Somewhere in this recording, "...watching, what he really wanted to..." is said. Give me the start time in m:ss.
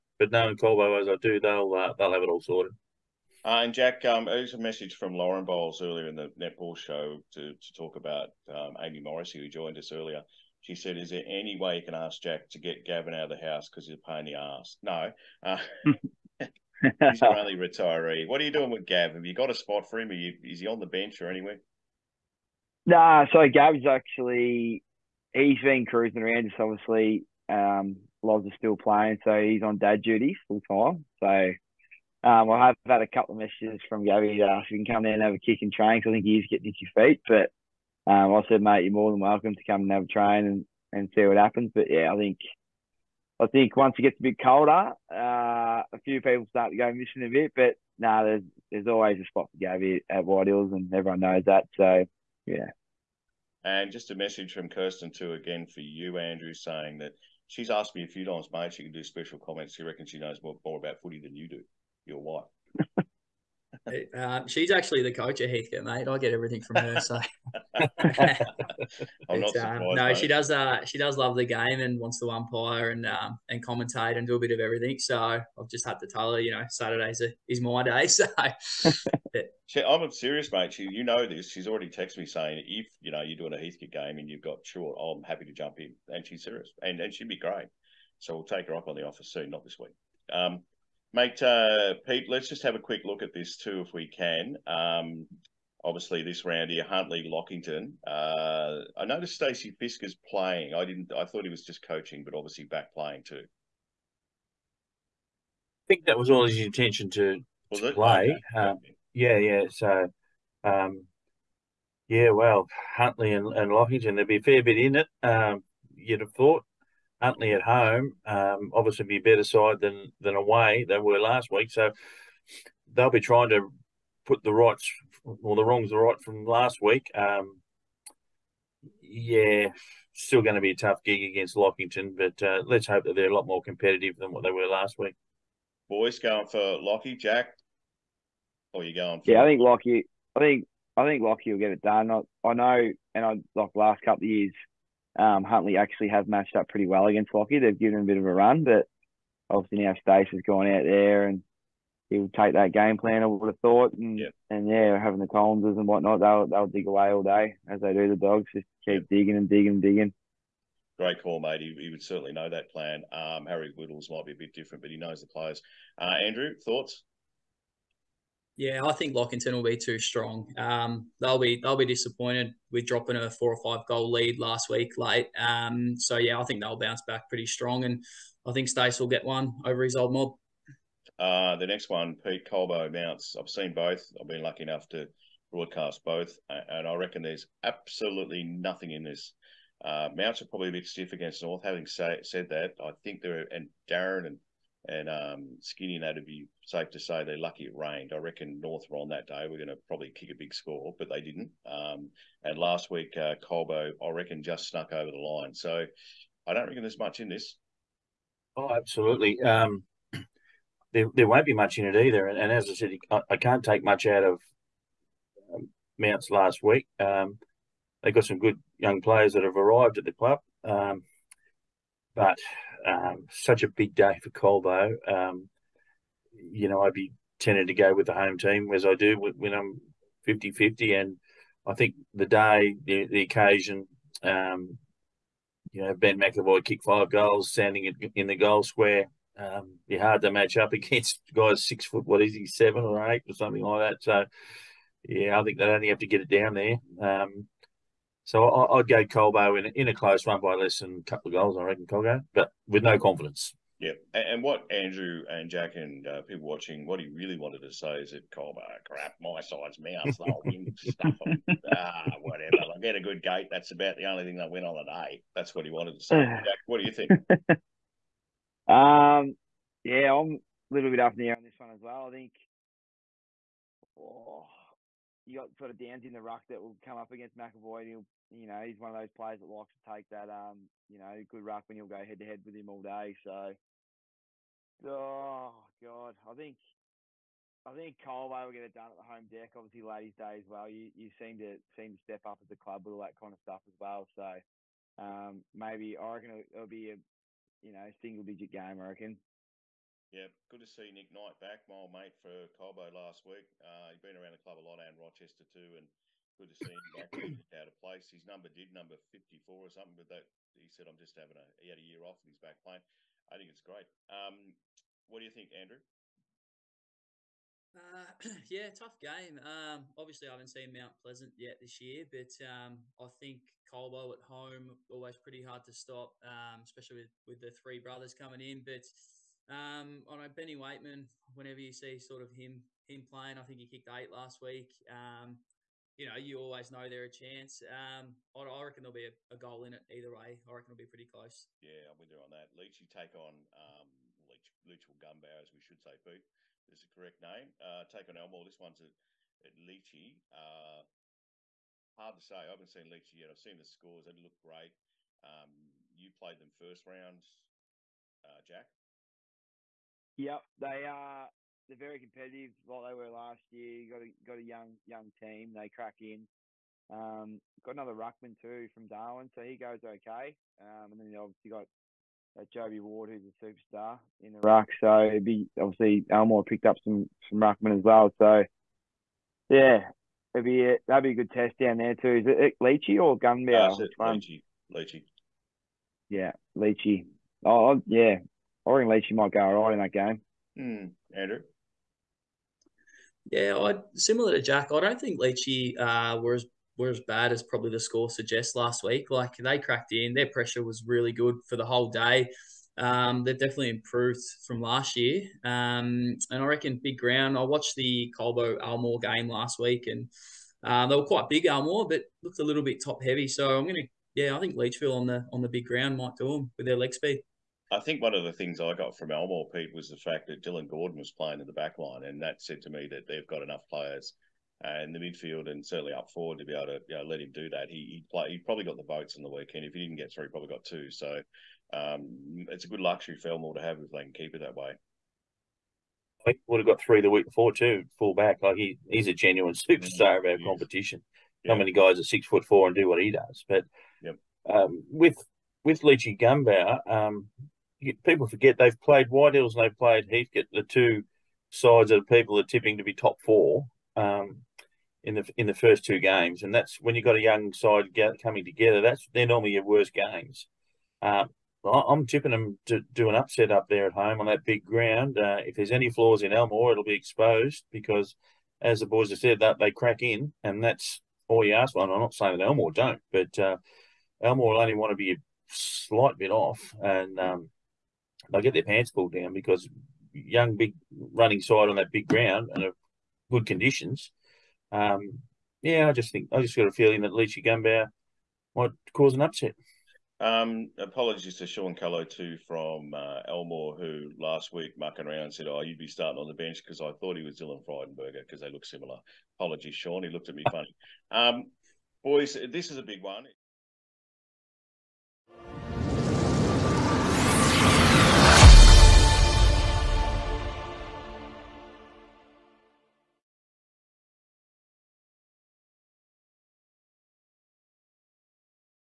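4:16.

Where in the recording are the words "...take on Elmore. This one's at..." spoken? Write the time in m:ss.
5:47.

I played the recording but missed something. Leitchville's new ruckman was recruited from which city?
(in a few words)
Darwin.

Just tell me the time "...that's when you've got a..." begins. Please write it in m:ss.
7:36.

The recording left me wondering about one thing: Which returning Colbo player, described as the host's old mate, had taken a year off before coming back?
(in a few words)
Nick Knight.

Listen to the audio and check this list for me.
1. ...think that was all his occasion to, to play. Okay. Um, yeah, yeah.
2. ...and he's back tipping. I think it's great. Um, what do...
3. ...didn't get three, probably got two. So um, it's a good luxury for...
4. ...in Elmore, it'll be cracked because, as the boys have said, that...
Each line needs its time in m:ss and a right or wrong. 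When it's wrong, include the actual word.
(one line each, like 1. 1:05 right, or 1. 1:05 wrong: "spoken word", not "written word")
1. 1:45 wrong: "intention", not "occasion"
2. 5:12 wrong: "playing", not "tipping"
3. 7:09 right
4. 7:46 wrong: "exposed", not "cracked".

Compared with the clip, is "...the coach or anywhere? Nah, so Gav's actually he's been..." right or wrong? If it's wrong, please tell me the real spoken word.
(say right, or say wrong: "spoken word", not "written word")
wrong: "bench", not "coach".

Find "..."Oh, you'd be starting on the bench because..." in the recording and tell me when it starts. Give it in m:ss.
8:15.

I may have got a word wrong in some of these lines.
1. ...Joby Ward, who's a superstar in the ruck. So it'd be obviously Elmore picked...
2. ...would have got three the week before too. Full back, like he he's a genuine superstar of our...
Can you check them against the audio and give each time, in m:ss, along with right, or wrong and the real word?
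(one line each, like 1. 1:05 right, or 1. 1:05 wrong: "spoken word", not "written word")
1. 6:12 right
2. 7:16 right.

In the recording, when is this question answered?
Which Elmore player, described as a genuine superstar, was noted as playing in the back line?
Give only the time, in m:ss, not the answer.
7:00.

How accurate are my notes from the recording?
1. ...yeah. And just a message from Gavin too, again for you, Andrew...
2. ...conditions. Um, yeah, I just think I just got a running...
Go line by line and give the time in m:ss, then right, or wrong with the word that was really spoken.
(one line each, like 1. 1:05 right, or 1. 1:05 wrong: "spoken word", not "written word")
1. 0:52 wrong: "Kirsten", not "Gavin"
2. 8:03 wrong: "feeling", not "running".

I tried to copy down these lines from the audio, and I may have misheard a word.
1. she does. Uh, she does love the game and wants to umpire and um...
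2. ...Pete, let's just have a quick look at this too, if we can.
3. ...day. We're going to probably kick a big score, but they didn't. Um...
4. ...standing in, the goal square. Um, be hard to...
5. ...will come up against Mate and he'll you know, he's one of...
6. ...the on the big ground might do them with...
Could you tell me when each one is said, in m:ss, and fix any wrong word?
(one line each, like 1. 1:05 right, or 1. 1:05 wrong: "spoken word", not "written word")
1. 1:10 right
2. 1:32 right
3. 3:19 right
4. 3:57 right
5. 4:36 wrong: "McEvoy", not "Mate"
6. 6:55 right.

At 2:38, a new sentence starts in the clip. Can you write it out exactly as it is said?
Just keep digging and digging and digging.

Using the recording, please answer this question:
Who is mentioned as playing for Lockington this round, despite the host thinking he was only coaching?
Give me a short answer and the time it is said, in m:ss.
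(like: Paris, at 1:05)
Stacey Fisker, at 1:39.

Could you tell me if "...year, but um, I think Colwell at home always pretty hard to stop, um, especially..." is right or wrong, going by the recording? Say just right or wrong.
right.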